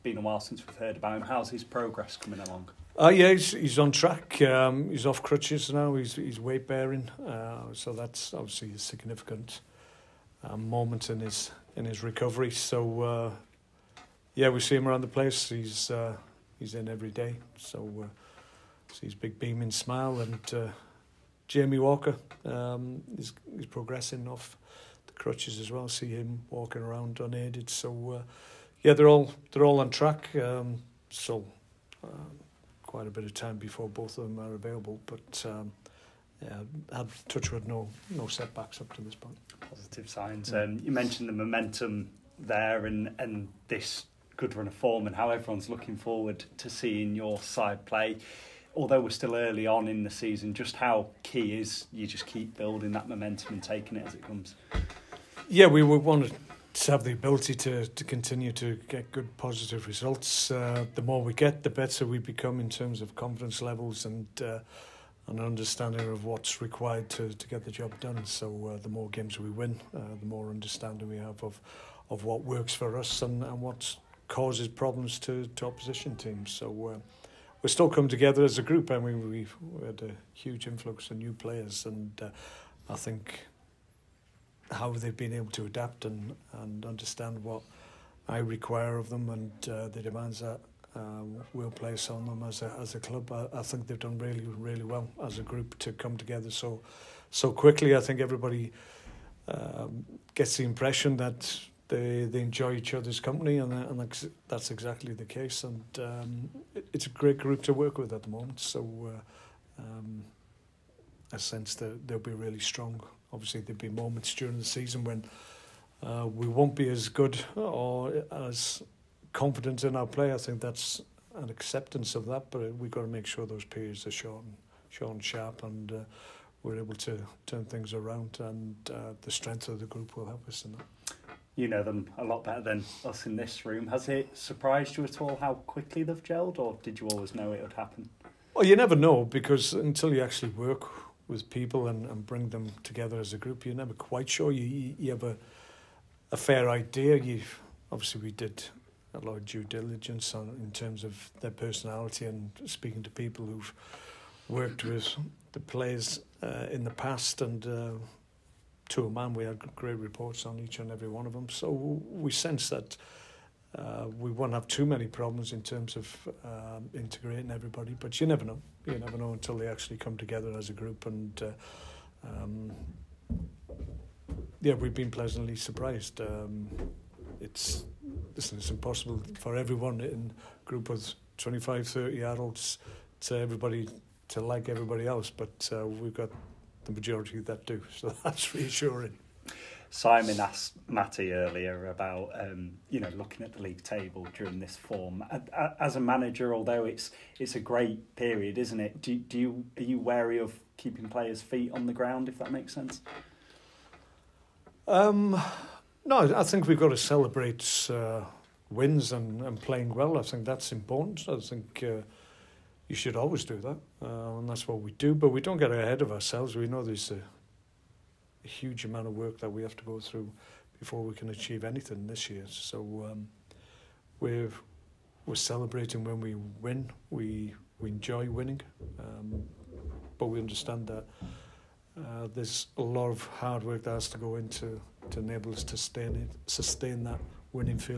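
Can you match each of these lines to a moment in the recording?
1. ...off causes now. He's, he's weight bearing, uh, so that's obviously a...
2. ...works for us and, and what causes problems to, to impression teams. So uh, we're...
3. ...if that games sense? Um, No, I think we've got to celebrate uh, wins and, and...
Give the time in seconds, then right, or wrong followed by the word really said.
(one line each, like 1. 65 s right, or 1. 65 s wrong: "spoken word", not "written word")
1. 5 s wrong: "crutches", not "causes"
2. 72 s wrong: "opposition", not "impression"
3. 202 s wrong: "makes", not "games".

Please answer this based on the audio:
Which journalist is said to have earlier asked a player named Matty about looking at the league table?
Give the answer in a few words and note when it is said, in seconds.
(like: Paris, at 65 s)
Simon, at 189 s.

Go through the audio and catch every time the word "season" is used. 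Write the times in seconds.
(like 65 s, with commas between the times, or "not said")
50 s, 114 s.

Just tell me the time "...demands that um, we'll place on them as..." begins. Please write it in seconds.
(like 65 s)
90 s.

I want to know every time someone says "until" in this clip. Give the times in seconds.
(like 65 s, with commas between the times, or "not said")
139 s, 169 s.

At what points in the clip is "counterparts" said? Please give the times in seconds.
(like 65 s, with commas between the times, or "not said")
not said.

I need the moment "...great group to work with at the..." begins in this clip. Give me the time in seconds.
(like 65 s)
107 s.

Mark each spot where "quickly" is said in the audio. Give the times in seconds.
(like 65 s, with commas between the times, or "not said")
97 s, 135 s.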